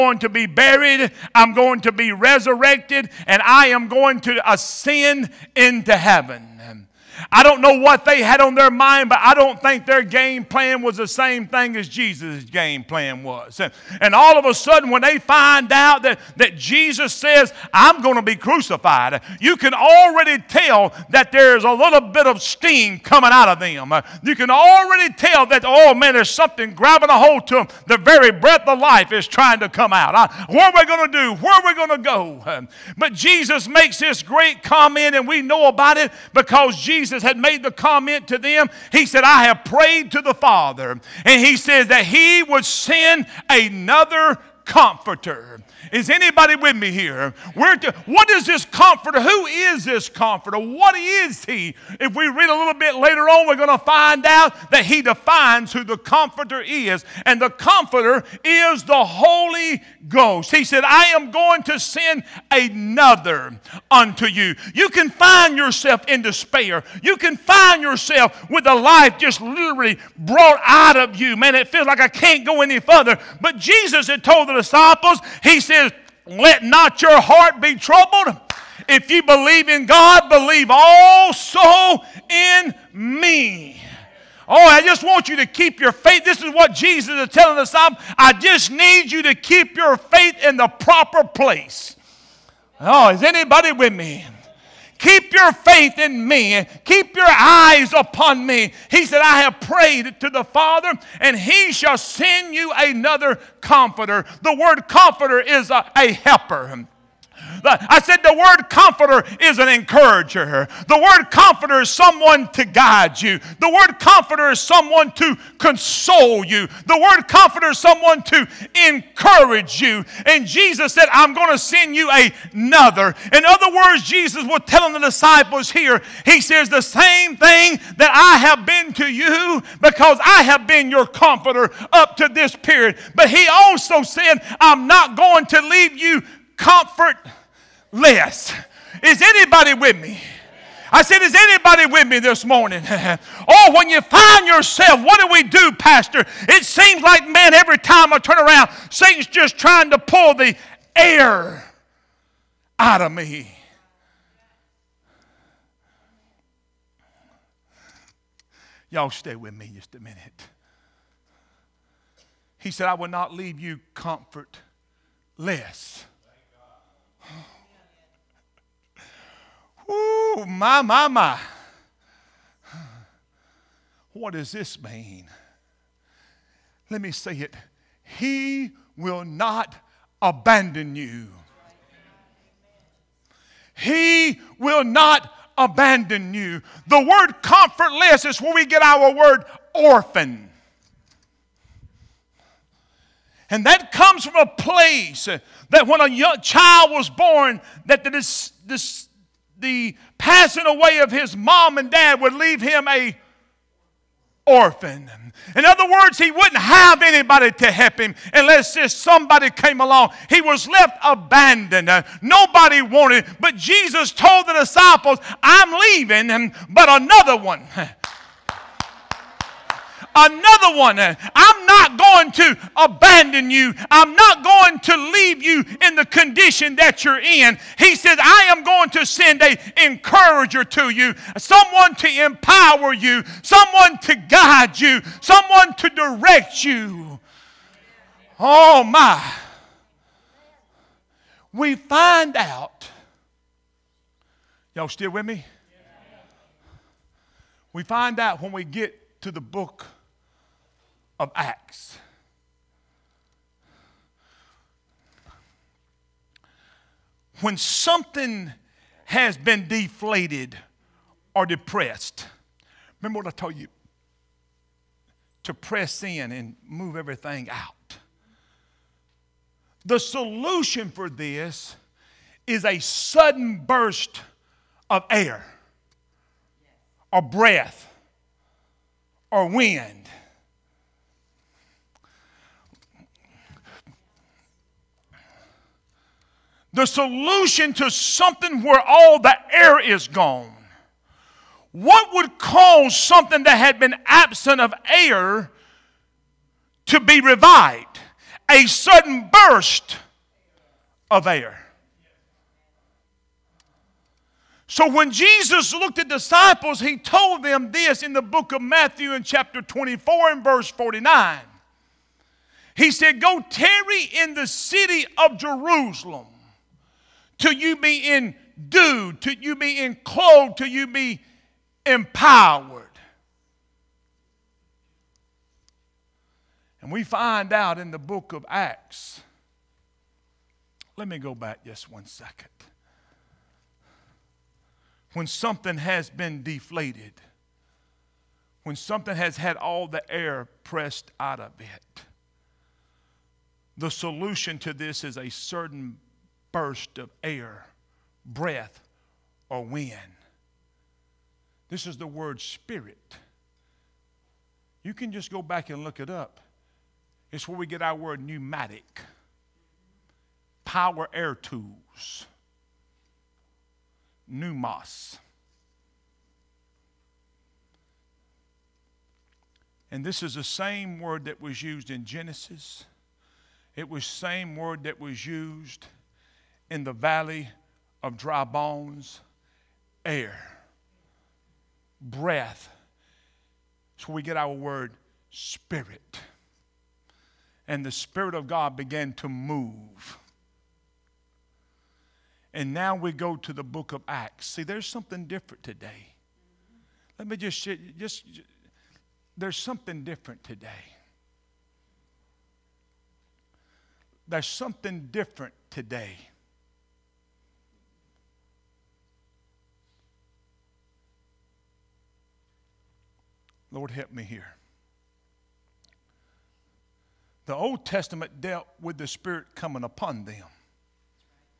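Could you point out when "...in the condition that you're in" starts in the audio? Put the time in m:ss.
3:45.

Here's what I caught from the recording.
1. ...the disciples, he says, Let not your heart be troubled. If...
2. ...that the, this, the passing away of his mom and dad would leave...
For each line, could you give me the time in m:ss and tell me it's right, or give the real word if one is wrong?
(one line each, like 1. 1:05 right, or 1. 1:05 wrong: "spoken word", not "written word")
1. 1:14 right
2. 3:17 right.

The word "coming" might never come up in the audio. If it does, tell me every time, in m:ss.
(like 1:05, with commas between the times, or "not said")
0:22, 6:59.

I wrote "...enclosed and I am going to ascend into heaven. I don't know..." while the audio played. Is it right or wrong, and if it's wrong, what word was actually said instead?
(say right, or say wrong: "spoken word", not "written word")
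wrong: "resurrected", not "enclosed".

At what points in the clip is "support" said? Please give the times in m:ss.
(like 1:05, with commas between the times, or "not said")
not said.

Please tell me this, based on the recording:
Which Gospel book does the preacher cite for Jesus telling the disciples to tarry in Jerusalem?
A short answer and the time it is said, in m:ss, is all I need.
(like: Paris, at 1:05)
Matthew, at 5:08.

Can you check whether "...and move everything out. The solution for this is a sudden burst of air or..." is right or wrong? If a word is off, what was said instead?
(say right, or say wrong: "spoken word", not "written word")
right.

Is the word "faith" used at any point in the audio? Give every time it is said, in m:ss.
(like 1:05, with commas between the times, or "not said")
1:25, 1:29, 1:35.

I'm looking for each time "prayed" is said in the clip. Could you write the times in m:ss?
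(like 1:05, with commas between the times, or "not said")
0:39, 1:39.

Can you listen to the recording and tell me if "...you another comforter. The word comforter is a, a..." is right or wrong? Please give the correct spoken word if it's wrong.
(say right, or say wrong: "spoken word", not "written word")
right.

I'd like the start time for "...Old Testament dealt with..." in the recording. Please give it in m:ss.
6:57.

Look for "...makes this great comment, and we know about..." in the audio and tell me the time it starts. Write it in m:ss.
0:33.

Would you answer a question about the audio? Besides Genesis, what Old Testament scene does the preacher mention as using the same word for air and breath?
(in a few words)
the valley of dry bones.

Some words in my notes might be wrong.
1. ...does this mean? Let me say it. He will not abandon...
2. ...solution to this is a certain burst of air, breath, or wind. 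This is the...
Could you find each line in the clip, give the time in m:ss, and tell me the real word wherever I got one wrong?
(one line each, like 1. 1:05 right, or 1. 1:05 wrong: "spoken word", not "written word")
1. 2:54 right
2. 5:43 right.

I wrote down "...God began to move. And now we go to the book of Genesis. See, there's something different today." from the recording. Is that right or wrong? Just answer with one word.
wrong.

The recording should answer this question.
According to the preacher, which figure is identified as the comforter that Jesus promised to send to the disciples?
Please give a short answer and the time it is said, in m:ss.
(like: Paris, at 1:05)
The Holy Ghost, at 0:58.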